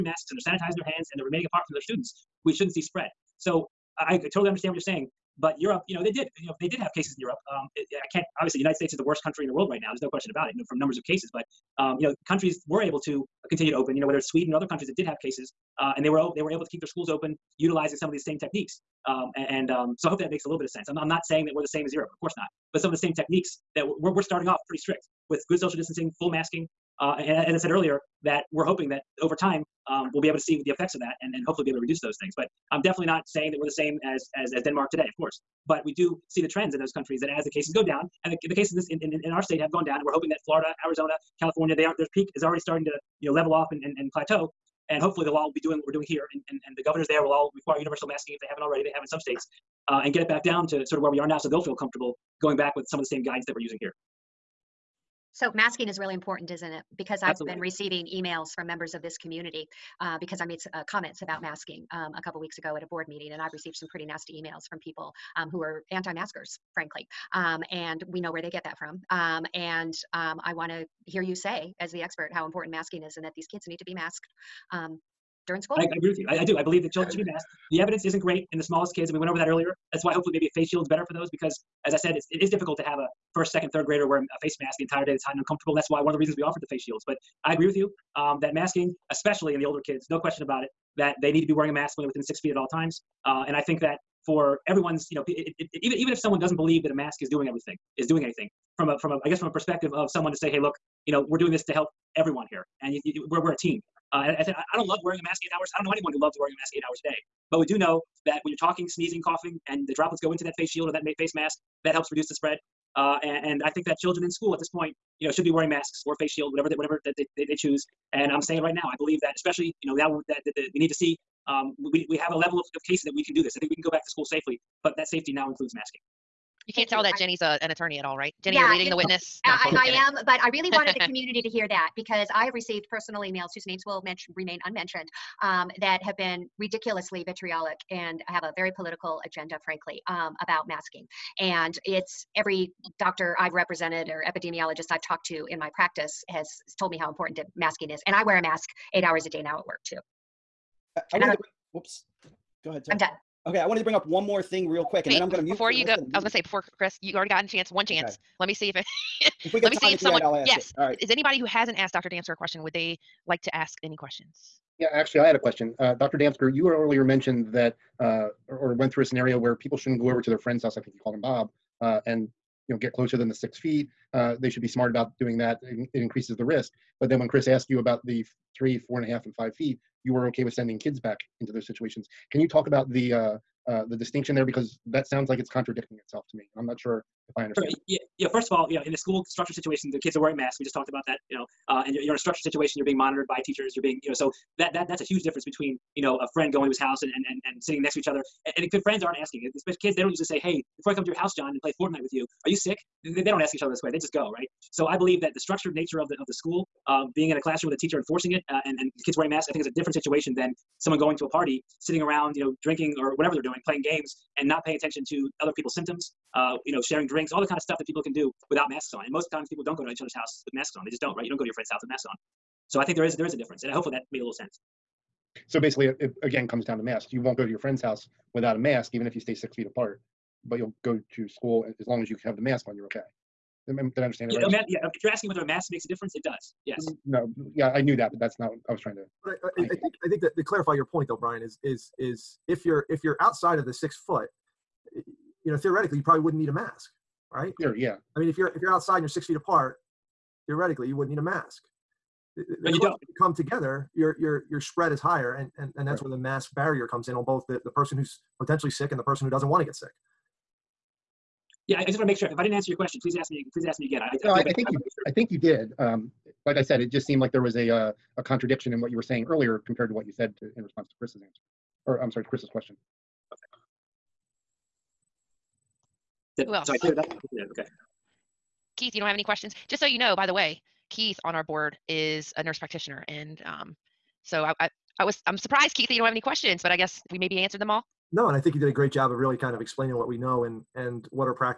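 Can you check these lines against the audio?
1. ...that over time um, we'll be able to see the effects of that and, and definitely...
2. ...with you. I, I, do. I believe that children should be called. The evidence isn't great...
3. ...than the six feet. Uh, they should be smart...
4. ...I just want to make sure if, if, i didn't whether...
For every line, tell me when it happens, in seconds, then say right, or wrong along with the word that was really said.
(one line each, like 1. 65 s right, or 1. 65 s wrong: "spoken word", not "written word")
1. 28 s wrong: "hopefully", not "definitely"
2. 76 s wrong: "masked", not "called"
3. 173 s right
4. 261 s wrong: "answer", not "whether".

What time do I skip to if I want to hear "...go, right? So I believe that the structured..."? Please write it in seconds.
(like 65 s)
204 s.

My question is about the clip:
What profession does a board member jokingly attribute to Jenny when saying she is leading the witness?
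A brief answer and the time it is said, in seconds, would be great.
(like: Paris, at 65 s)
attorney, at 127 s.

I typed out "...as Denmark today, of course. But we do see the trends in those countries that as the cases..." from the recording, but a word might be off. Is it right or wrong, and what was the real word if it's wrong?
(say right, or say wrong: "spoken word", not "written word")
right.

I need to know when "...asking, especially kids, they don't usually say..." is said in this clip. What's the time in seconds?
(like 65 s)
199 s.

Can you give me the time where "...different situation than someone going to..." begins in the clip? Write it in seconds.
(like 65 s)
209 s.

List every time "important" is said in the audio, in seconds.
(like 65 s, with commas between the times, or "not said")
56 s, 72 s, 147 s.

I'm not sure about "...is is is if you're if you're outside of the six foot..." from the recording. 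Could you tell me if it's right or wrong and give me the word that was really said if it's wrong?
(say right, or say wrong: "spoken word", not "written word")
right.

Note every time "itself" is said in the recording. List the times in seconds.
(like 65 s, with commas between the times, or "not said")
186 s.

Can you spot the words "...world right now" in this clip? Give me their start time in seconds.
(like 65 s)
9 s.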